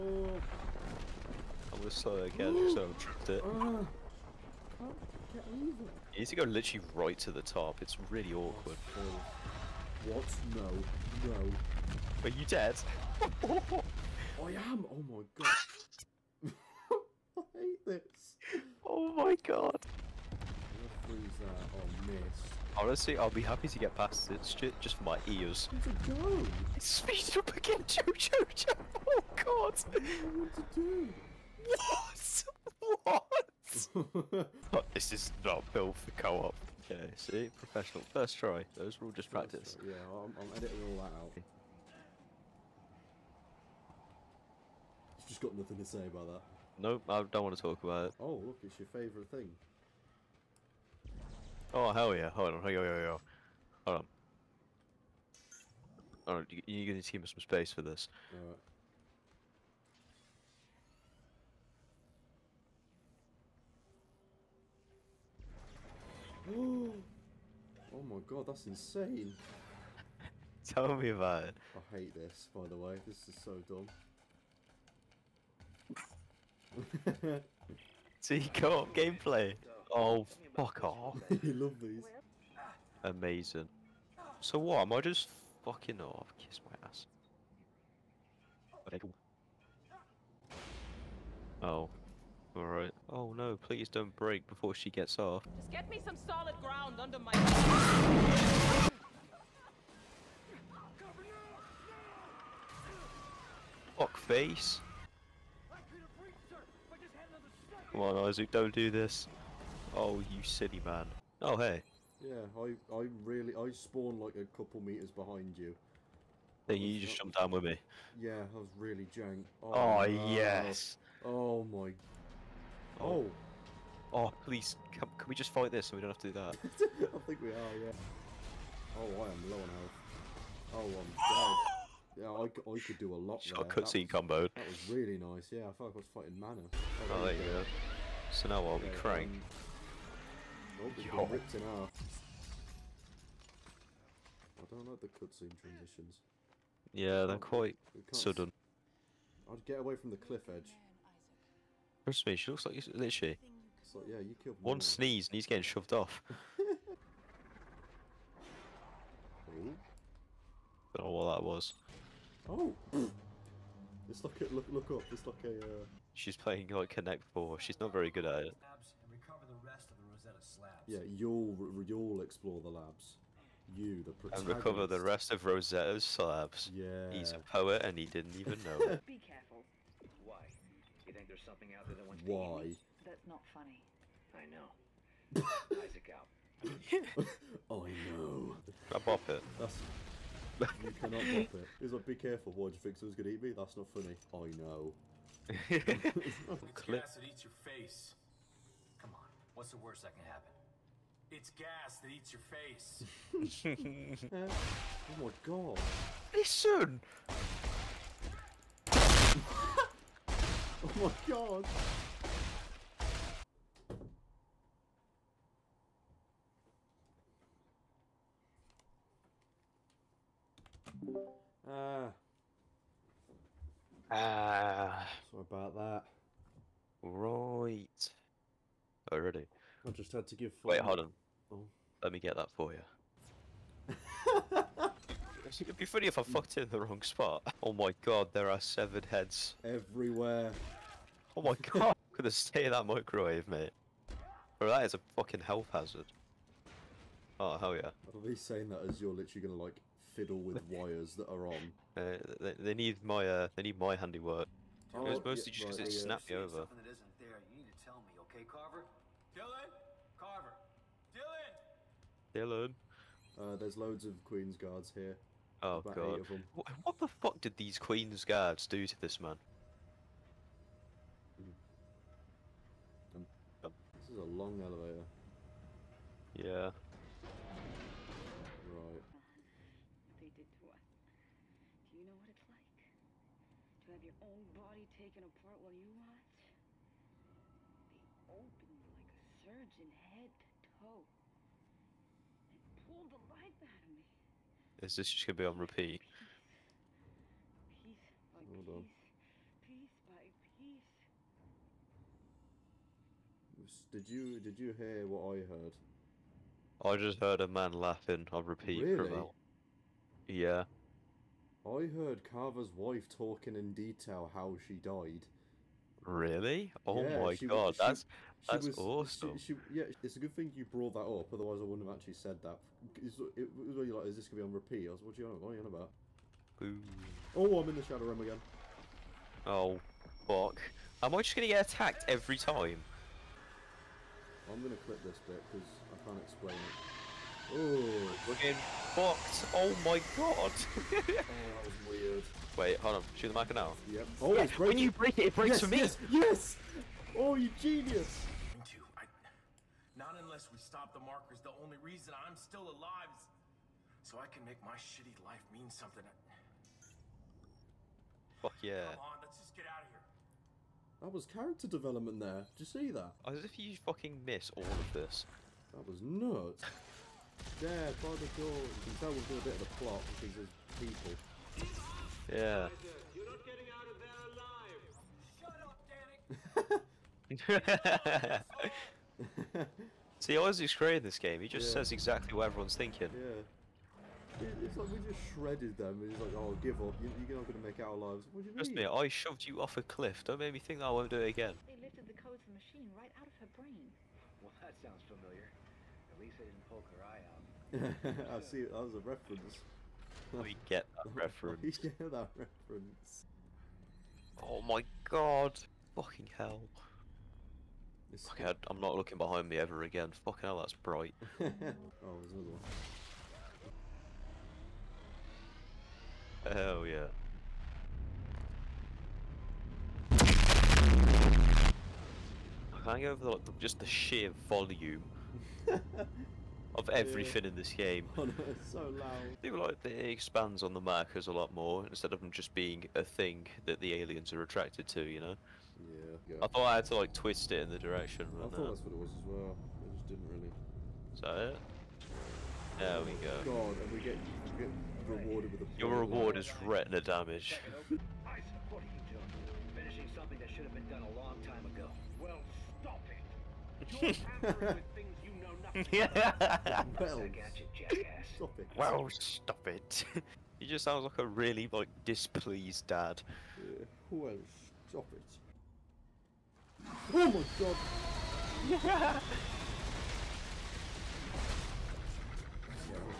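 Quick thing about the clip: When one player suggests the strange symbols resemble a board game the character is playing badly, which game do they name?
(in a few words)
Connect Four.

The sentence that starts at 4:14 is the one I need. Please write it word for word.
Oh, it was mostly yeah, just because right, it yeah.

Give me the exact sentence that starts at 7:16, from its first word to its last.
I thought I had to like twist it in the direction.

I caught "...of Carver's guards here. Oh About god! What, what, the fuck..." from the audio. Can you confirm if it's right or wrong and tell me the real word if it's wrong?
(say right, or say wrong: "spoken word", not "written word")
wrong: "Queen", not "Carver".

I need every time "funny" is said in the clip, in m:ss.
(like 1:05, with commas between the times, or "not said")
3:03, 3:13, 3:55.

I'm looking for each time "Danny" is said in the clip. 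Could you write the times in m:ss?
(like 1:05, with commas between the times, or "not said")
6:15.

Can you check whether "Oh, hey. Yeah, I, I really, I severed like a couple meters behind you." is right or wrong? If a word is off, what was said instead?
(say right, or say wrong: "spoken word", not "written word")
wrong: "spawned", not "severed".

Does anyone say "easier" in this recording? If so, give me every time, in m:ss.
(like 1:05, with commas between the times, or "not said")
not said.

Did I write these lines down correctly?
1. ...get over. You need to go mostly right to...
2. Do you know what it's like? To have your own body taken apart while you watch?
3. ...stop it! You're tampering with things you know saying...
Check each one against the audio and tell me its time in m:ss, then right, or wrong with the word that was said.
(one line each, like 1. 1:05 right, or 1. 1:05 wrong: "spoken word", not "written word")
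1. 0:05 wrong: "literally", not "mostly"
2. 4:41 right
3. 7:32 wrong: "nothing", not "saying".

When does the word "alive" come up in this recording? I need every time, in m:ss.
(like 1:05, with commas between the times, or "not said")
5:52, 6:14.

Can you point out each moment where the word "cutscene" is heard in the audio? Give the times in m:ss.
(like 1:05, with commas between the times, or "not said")
2:13, 2:25.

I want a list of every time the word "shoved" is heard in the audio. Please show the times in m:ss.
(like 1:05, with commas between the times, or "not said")
2:35, 6:29.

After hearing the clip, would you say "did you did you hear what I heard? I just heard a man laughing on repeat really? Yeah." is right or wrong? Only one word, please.
right.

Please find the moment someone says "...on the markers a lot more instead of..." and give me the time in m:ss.
7:10.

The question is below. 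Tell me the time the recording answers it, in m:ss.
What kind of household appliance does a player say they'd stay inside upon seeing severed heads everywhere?
4:02.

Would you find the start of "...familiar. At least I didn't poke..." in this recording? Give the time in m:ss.
6:35.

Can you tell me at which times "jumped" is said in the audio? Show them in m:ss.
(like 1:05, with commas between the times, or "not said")
1:57.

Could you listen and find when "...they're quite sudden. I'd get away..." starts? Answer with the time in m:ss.
2:27.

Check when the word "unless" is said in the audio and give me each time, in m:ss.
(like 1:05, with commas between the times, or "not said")
5:50.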